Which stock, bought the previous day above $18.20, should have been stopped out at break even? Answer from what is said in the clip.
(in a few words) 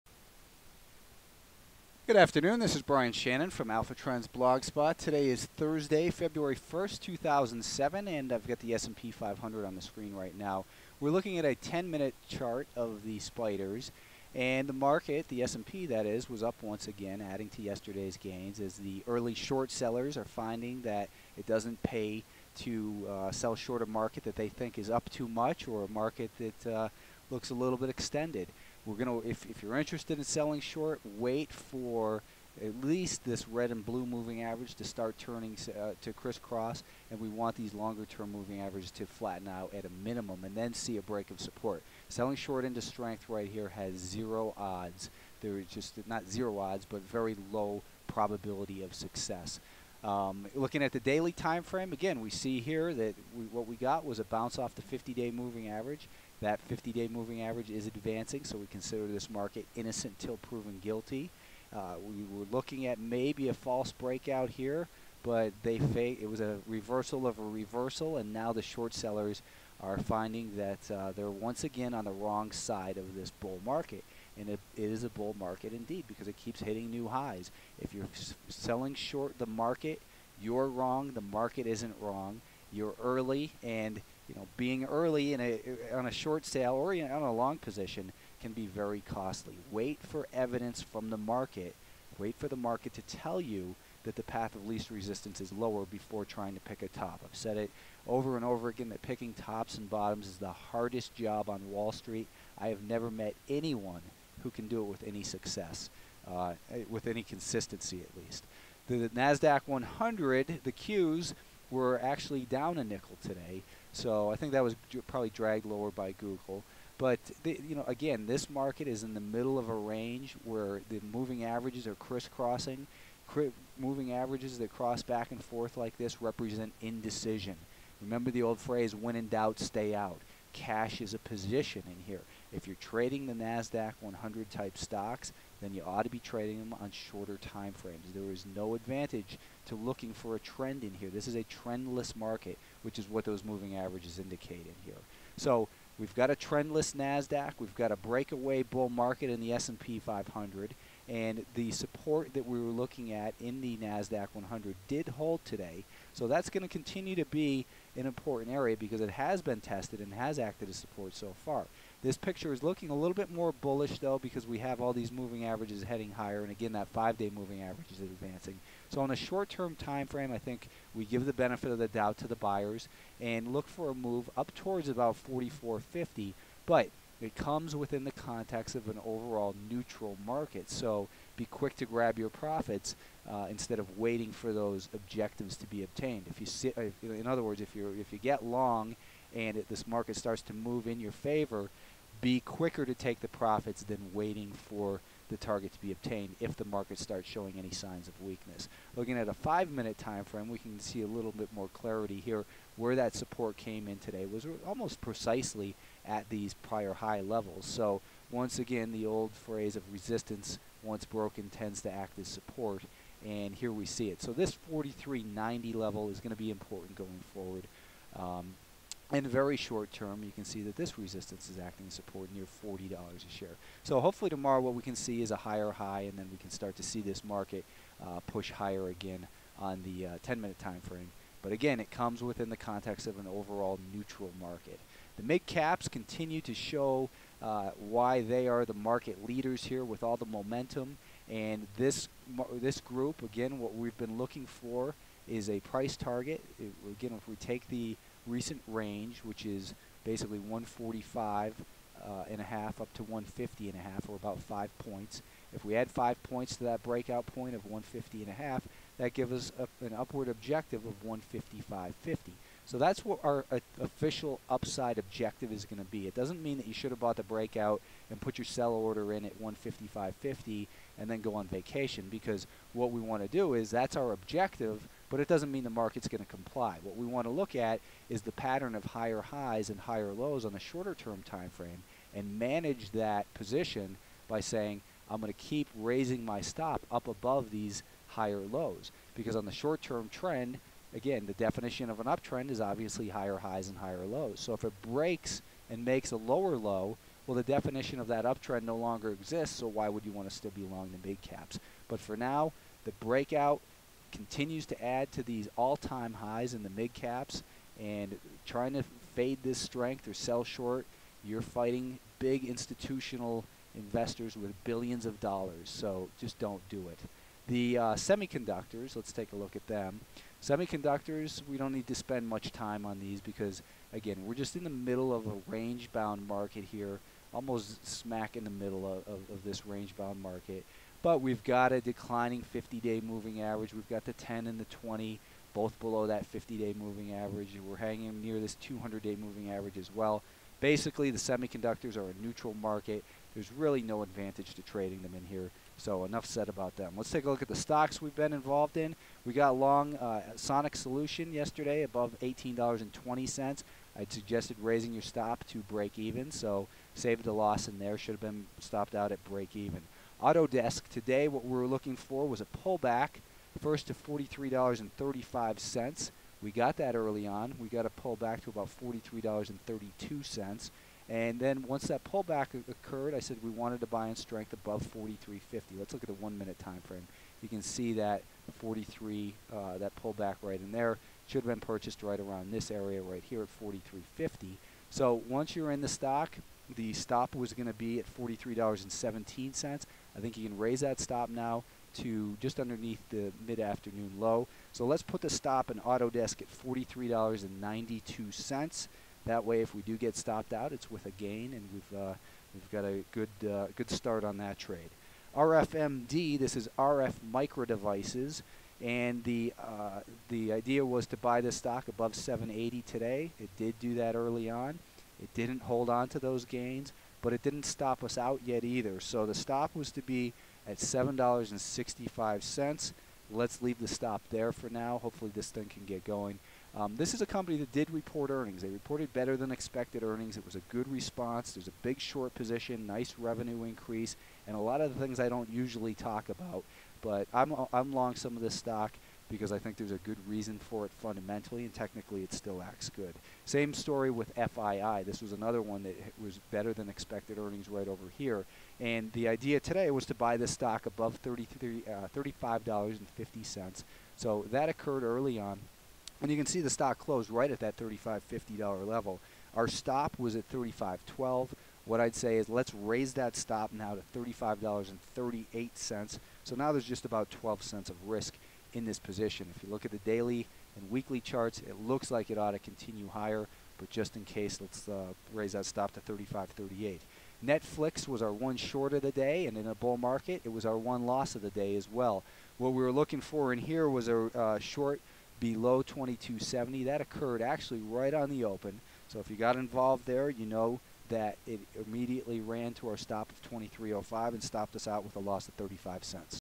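Sonic Solution.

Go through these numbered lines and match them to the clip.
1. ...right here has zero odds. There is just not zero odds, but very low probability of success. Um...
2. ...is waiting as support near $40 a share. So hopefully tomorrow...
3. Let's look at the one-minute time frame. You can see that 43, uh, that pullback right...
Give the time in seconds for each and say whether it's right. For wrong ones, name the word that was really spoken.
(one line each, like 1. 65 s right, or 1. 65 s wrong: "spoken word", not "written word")
1. 43 s right
2. 221 s wrong: "acting", not "waiting"
3. 375 s right.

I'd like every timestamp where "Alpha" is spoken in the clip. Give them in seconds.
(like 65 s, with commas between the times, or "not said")
3 s.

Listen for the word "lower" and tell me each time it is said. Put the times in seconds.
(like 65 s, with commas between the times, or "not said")
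95 s, 115 s, 296 s.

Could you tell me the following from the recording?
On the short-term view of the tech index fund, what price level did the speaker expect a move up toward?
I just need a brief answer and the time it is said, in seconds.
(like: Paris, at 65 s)
44.50, at 175 s.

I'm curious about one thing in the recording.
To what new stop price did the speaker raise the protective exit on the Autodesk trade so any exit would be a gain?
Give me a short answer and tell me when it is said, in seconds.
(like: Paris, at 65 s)
$43.92, at 396 s.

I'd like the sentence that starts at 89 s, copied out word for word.
Wait for evidence from the market.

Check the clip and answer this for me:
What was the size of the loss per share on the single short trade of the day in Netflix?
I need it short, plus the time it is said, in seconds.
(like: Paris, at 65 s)
35 cents, at 495 s.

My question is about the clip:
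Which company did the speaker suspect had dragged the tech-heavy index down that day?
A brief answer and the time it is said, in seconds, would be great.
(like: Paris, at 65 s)
Google, at 116 s.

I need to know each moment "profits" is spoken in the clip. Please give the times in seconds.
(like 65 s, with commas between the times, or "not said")
182 s, 193 s.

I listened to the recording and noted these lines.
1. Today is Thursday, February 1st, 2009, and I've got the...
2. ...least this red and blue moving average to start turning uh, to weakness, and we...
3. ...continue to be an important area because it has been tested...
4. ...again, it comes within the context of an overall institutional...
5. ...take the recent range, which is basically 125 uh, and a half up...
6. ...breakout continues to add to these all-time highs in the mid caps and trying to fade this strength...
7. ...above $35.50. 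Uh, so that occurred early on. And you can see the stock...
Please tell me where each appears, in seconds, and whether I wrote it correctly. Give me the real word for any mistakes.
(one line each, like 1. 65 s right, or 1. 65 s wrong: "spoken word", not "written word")
1. 4 s wrong: "2007", not "2009"
2. 32 s wrong: "crisscross", not "weakness"
3. 156 s right
4. 231 s wrong: "neutral", not "institutional"
5. 247 s wrong: "145", not "125"
6. 302 s right
7. 450 s right.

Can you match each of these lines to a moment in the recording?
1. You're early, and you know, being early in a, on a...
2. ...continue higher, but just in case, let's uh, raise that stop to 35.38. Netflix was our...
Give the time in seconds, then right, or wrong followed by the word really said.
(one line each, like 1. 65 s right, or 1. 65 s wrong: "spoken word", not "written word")
1. 82 s right
2. 472 s right.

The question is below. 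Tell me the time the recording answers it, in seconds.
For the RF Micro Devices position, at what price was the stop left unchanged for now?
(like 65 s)
420 s.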